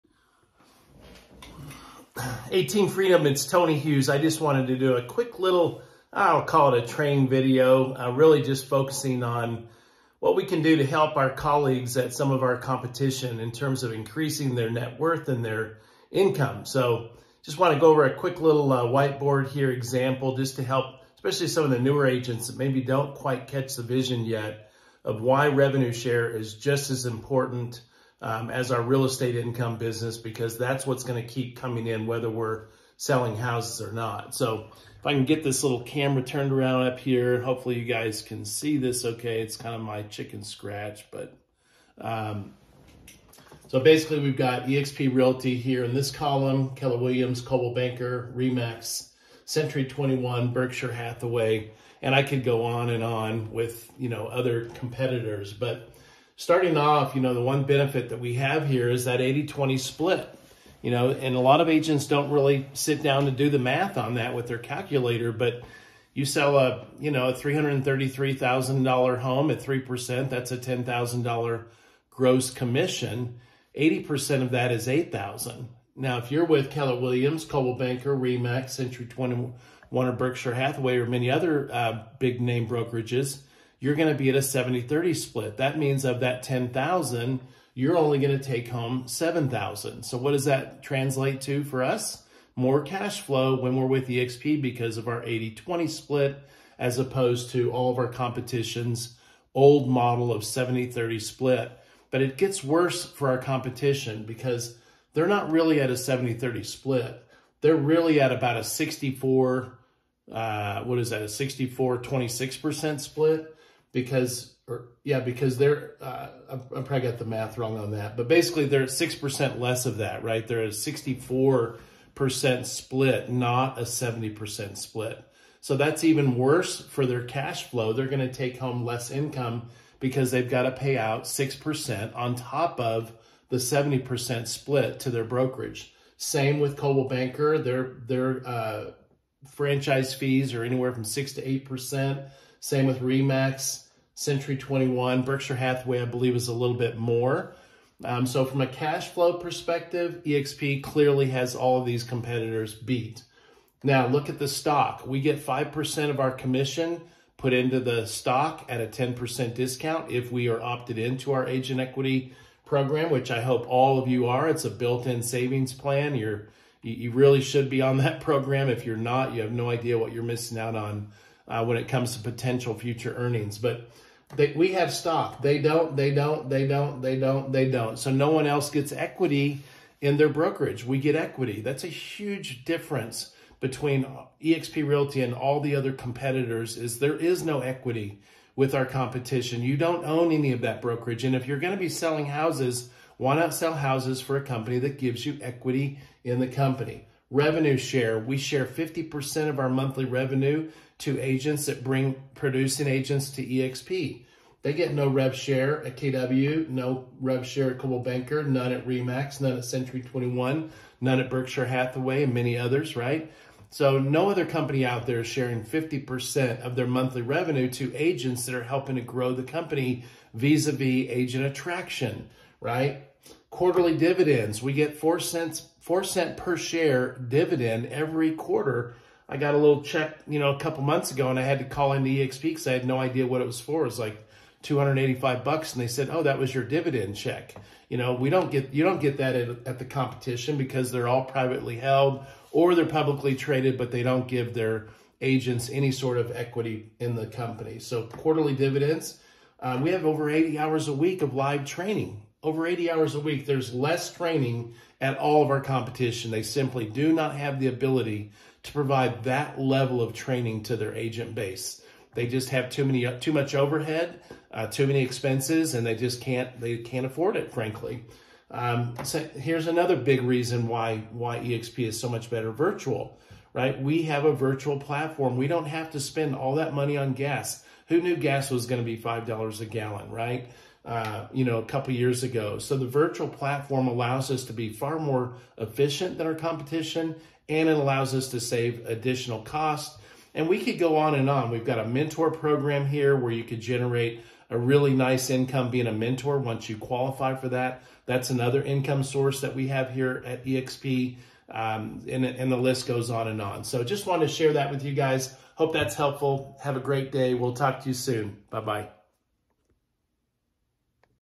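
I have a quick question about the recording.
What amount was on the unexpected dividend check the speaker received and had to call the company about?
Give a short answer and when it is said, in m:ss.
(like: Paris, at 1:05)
$285, at 3:54.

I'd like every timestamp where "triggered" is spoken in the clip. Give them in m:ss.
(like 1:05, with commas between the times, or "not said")
not said.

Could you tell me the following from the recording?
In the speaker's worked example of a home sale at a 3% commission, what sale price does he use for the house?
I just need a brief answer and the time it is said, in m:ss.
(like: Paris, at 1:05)
$333,000, at 1:07.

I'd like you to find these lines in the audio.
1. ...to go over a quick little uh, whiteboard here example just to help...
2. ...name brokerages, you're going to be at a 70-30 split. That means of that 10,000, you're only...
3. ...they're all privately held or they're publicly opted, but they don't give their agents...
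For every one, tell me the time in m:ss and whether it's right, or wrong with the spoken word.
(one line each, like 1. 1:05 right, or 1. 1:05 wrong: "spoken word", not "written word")
1. 0:17 right
2. 1:22 right
3. 4:00 wrong: "traded", not "opted".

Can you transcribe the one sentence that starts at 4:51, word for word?
We've got a mentor program here where you could generate a really nice income being a mentor once you qualify for that.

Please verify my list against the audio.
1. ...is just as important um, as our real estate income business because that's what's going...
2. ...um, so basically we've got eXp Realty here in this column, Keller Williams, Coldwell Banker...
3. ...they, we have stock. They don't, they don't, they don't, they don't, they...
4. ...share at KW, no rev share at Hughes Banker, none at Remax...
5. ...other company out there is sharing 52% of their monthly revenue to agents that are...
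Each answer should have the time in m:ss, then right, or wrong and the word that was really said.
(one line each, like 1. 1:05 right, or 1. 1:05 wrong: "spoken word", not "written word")
1. 0:26 right
2. 0:41 right
3. 2:54 right
4. 3:25 wrong: "Coldwell", not "Hughes"
5. 3:34 wrong: "50", not "52".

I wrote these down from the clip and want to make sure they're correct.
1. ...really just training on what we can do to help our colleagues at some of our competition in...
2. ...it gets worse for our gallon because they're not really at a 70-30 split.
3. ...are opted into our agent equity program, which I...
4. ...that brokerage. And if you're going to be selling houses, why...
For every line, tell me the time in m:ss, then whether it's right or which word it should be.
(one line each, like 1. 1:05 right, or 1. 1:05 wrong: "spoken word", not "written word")
1. 0:08 wrong: "focusing", not "training"
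2. 1:42 wrong: "competition", not "gallon"
3. 2:40 right
4. 3:10 right.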